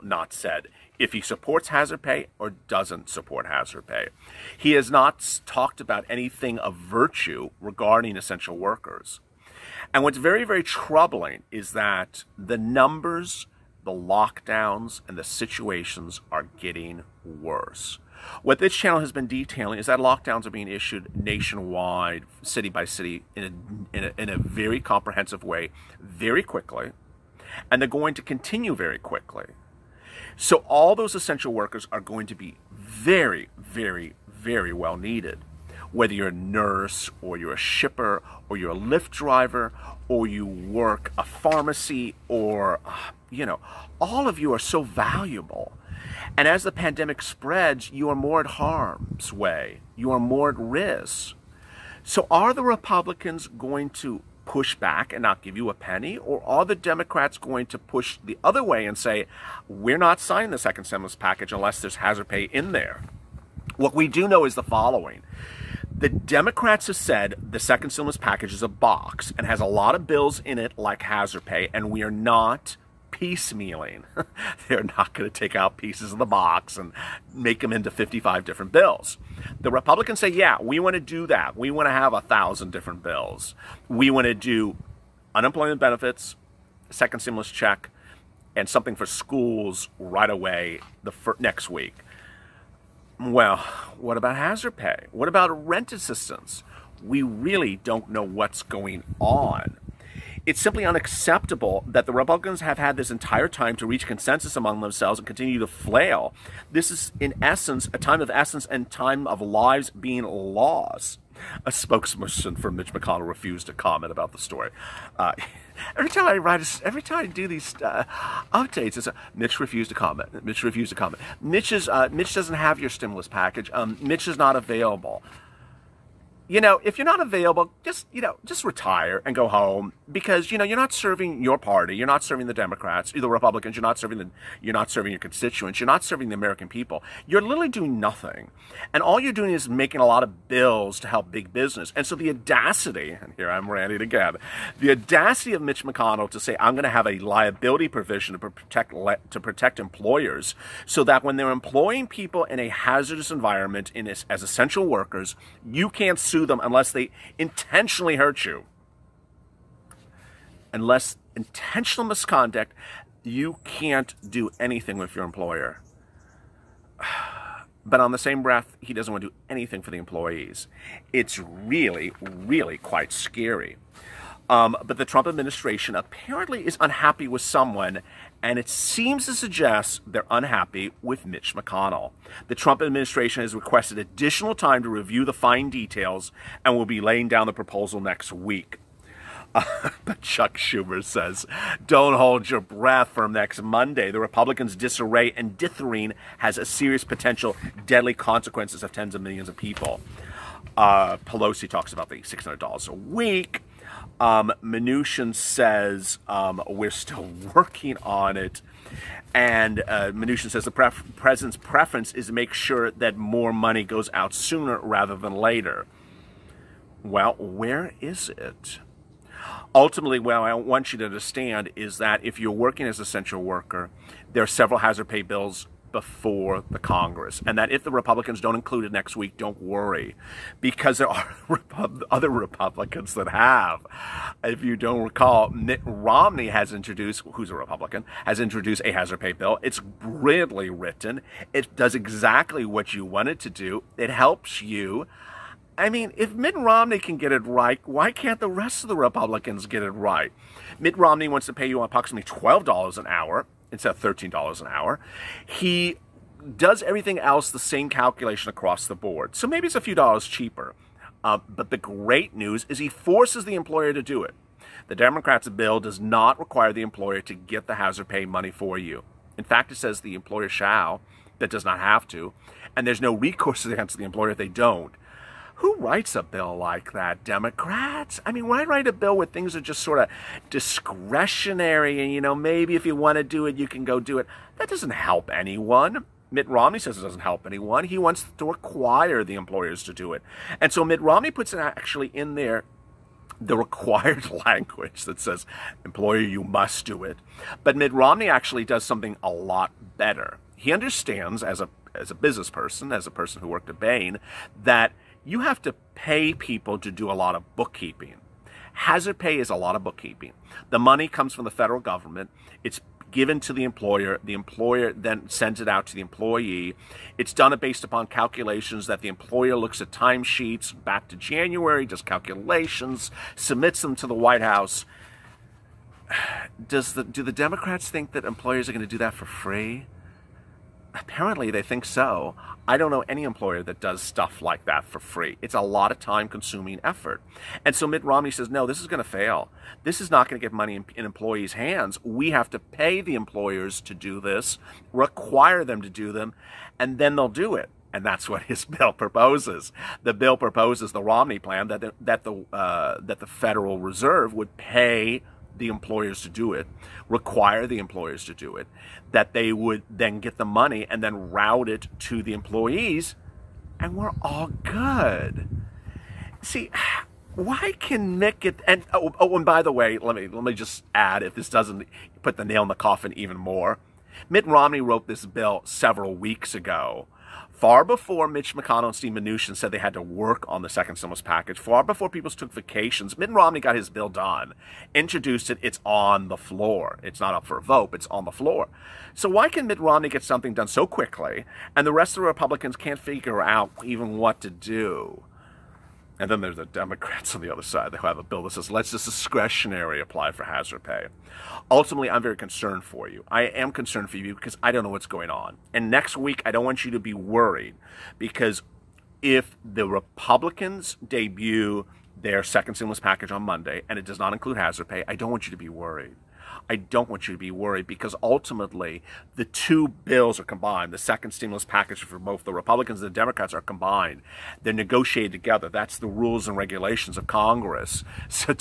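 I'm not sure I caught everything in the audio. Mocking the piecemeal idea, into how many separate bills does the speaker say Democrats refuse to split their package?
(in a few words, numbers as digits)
55.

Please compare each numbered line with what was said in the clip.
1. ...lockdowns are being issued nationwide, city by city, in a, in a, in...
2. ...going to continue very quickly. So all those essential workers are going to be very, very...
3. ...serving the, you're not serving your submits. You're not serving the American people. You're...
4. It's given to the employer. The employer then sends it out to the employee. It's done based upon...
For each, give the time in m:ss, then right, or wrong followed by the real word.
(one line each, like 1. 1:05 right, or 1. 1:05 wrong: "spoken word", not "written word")
1. 0:19 right
2. 0:27 right
3. 2:13 wrong: "constituents", not "submits"
4. 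5:12 right.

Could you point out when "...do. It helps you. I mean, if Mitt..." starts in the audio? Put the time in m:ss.
4:03.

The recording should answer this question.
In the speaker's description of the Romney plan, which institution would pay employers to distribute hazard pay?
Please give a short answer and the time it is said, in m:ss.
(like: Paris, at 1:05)
Federal Reserve, at 5:53.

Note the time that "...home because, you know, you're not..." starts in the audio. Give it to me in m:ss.
2:09.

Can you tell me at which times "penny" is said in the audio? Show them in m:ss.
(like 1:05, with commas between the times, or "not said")
0:55.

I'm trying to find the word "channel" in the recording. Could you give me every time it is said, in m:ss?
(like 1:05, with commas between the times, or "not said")
0:18.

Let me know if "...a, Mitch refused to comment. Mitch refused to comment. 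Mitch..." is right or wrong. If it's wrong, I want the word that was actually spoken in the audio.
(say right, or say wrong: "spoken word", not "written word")
right.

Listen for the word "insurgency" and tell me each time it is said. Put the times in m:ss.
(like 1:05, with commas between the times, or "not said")
not said.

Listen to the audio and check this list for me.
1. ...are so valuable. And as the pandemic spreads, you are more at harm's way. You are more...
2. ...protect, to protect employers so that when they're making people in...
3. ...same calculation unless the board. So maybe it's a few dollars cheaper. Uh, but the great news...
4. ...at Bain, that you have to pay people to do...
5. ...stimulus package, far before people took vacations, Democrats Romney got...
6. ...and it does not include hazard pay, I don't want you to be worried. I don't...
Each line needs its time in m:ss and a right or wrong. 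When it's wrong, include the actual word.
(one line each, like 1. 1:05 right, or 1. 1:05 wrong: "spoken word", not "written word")
1. 0:44 right
2. 2:28 wrong: "employing", not "making"
3. 4:17 wrong: "across", not "unless"
4. 5:03 right
5. 6:20 wrong: "Mitt", not "Democrats"
6. 6:53 right.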